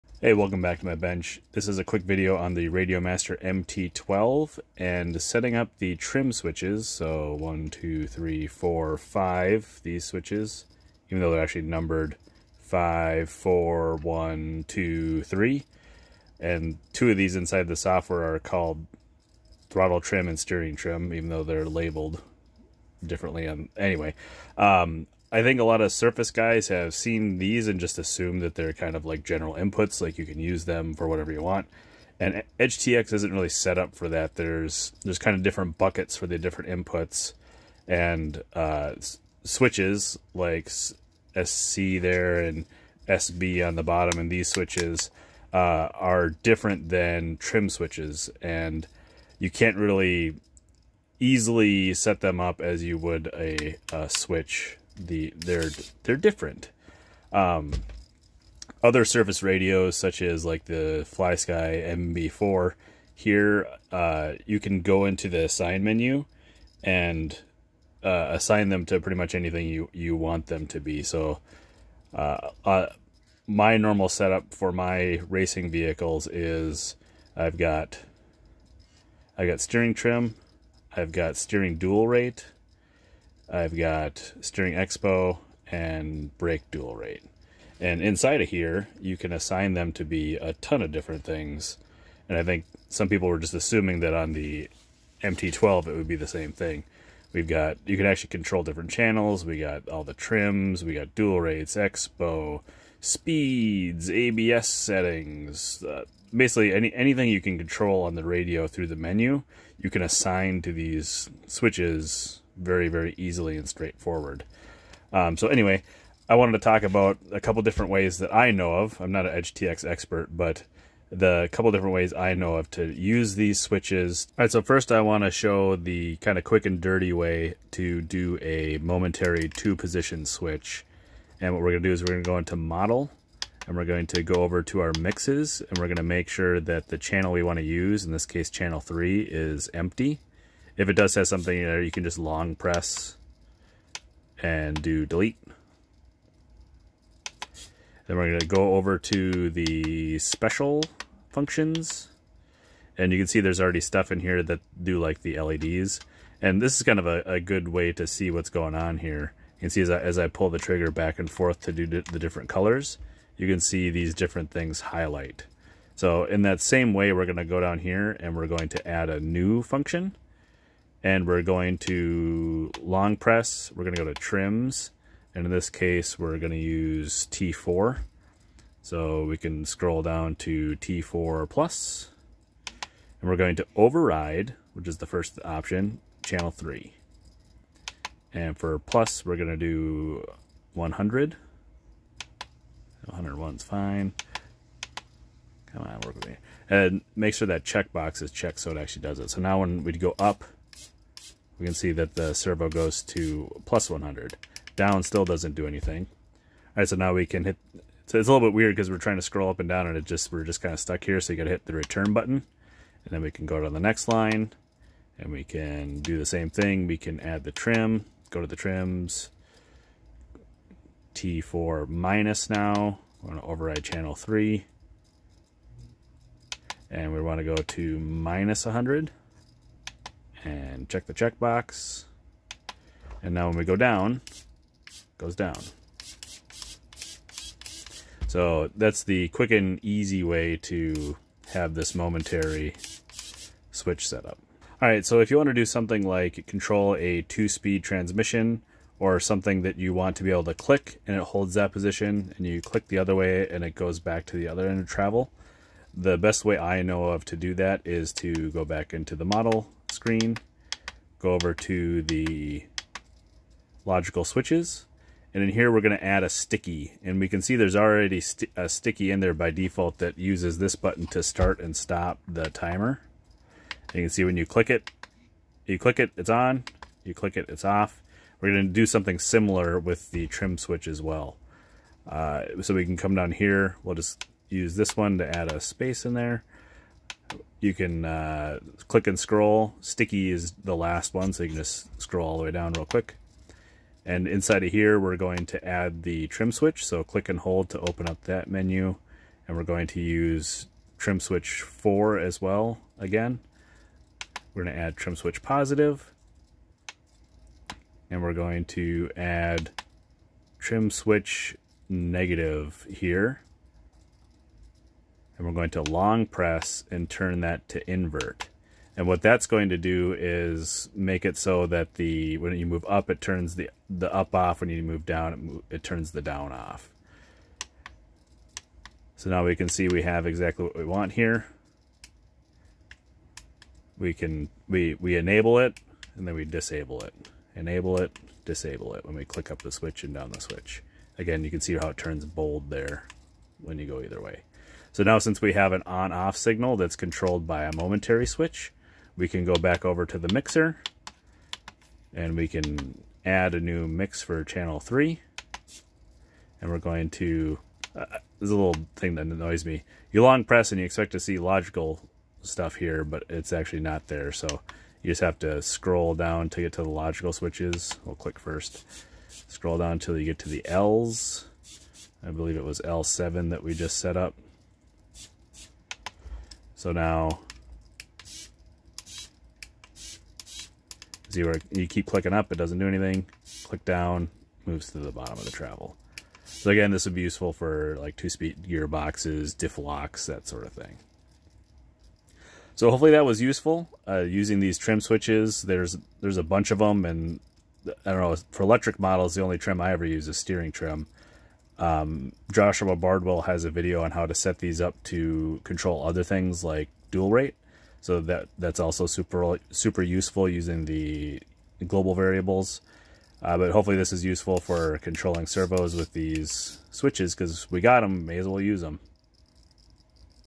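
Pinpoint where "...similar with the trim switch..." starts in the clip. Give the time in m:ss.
4:39.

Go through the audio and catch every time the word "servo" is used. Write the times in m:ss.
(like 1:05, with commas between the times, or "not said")
3:22, 6:55.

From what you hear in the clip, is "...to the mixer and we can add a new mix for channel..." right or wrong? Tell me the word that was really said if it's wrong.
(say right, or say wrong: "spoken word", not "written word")
right.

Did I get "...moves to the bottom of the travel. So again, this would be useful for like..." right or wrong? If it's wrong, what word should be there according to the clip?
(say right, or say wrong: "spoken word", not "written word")
right.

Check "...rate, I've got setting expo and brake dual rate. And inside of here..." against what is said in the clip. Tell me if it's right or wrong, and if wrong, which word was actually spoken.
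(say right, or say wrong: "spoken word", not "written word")
wrong: "steering", not "setting".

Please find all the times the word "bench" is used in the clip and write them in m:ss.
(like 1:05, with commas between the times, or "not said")
0:00.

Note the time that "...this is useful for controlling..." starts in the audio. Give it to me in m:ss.
6:53.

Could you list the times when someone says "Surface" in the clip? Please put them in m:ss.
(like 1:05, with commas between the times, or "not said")
0:25, 0:59.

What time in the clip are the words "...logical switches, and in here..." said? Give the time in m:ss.
4:23.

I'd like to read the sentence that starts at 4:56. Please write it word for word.
So click and hold to open up that menu.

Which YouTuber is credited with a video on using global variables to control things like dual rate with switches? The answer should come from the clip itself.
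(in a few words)
Joshua Bardwell.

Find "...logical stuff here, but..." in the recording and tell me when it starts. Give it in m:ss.
6:01.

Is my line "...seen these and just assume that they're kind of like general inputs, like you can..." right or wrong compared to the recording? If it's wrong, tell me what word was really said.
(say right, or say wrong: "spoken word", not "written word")
right.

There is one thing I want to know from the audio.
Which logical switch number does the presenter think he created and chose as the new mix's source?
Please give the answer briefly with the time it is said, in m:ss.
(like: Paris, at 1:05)
L7, at 6:12.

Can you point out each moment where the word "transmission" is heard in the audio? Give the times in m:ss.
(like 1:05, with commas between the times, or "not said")
4:07.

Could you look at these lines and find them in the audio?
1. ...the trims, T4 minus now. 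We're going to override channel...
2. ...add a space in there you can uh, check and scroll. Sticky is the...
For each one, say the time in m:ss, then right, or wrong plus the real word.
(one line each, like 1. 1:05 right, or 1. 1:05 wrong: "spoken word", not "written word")
1. 3:38 right
2. 4:45 wrong: "click", not "check".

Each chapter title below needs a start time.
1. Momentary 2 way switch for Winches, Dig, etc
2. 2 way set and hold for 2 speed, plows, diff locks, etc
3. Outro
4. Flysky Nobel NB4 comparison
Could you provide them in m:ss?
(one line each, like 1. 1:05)
1. 2:03
2. 4:04
3. 6:31
4. 0:57.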